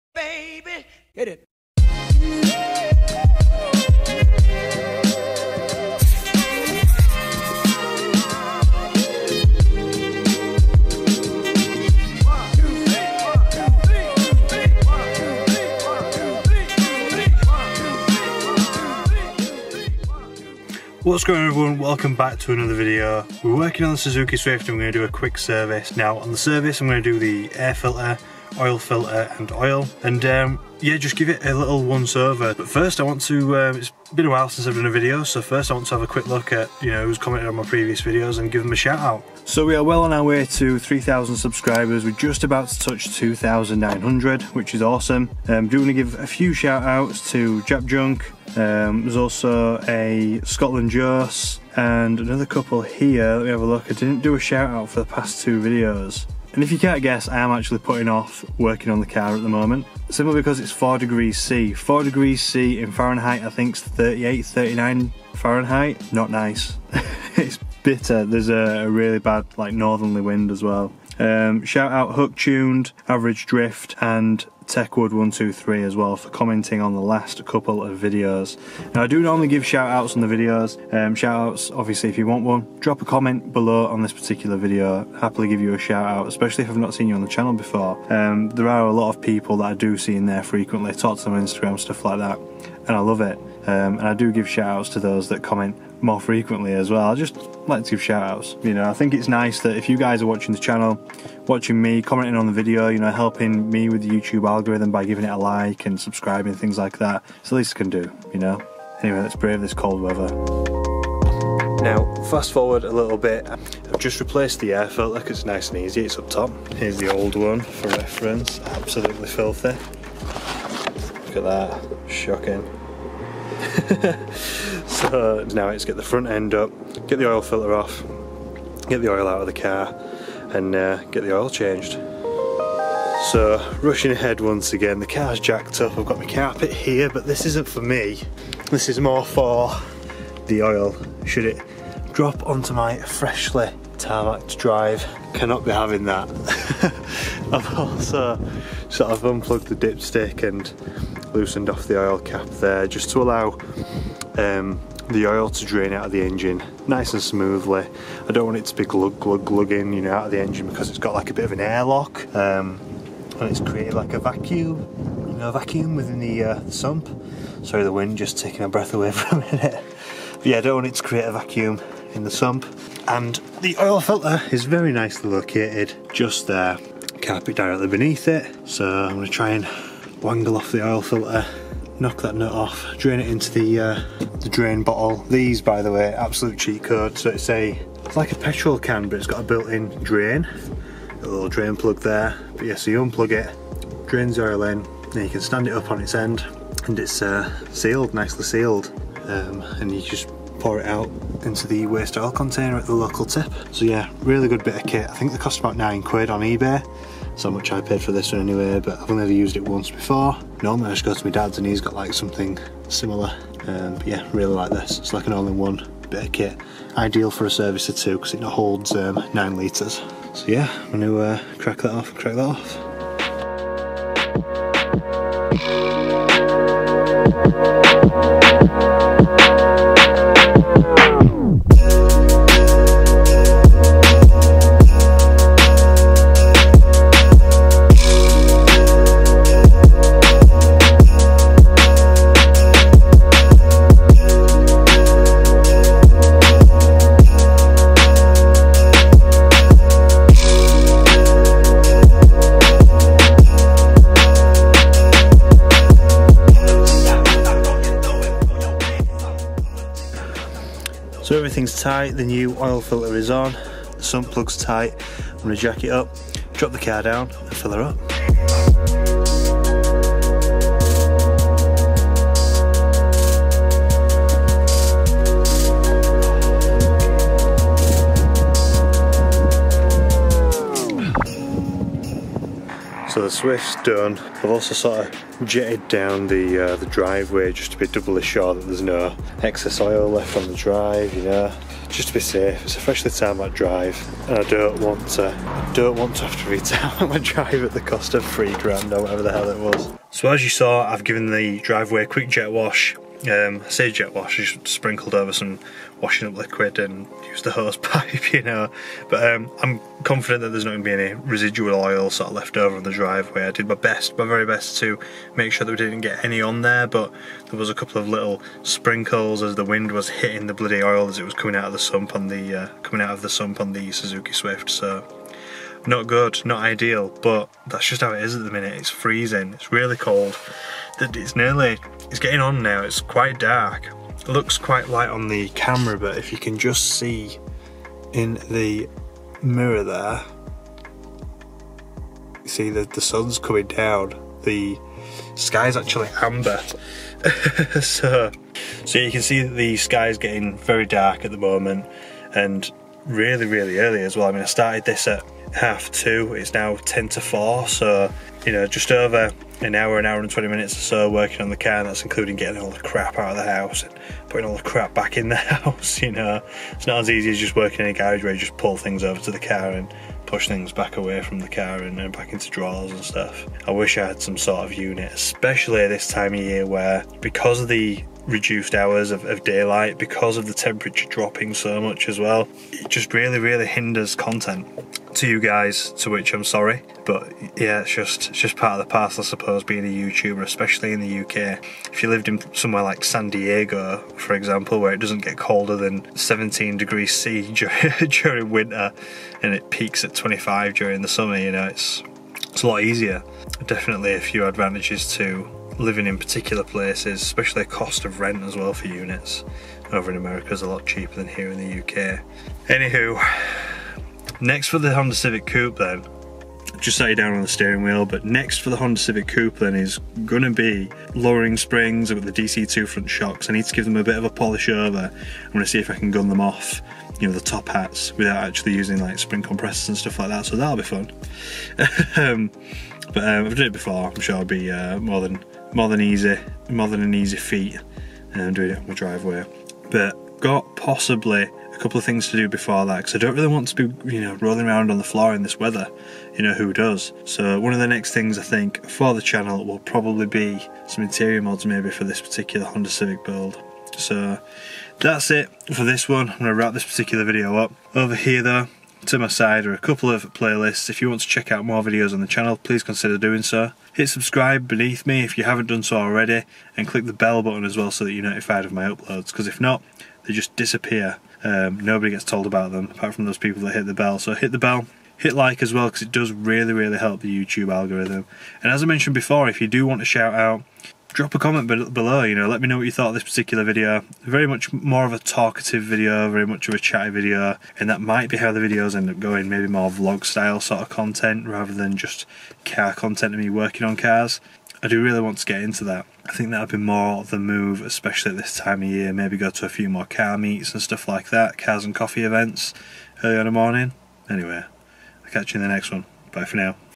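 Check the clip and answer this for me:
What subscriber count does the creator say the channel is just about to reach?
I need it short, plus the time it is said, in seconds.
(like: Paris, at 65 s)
2,900, at 43 s.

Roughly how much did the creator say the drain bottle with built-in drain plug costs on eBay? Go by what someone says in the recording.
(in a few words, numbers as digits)
9 quid.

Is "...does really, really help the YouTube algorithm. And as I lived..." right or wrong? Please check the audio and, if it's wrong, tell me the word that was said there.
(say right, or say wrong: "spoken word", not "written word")
wrong: "mentioned", not "lived".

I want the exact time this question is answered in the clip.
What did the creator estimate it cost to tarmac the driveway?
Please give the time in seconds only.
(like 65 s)
298 s.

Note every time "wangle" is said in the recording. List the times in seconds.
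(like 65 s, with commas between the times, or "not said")
180 s.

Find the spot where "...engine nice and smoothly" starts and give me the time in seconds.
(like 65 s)
156 s.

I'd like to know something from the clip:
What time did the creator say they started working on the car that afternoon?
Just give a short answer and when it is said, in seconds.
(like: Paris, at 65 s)
Half two, at 355 s.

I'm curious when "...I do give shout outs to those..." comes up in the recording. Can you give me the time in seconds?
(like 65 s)
94 s.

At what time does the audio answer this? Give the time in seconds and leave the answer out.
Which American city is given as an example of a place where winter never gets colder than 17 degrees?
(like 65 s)
393 s.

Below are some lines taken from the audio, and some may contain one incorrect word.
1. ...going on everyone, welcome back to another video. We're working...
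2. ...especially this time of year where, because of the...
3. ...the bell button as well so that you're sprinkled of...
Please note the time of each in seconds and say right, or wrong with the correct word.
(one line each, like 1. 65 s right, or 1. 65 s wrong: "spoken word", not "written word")
1. 21 s right
2. 375 s right
3. 467 s wrong: "notified", not "sprinkled".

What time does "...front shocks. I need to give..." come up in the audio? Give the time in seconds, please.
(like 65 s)
422 s.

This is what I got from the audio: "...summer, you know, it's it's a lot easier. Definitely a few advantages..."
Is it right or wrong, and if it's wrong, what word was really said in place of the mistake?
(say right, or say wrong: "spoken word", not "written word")
right.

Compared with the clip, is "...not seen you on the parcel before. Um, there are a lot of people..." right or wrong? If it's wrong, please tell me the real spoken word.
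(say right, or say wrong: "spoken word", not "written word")
wrong: "channel", not "parcel".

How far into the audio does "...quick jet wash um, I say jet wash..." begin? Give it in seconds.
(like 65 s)
302 s.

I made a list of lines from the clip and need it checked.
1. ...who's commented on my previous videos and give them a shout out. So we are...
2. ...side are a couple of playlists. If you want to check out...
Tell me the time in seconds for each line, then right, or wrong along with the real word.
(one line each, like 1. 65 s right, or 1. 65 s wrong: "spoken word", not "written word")
1. 37 s right
2. 459 s right.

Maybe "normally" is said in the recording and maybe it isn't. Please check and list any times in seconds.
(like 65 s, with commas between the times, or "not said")
79 s, 210 s.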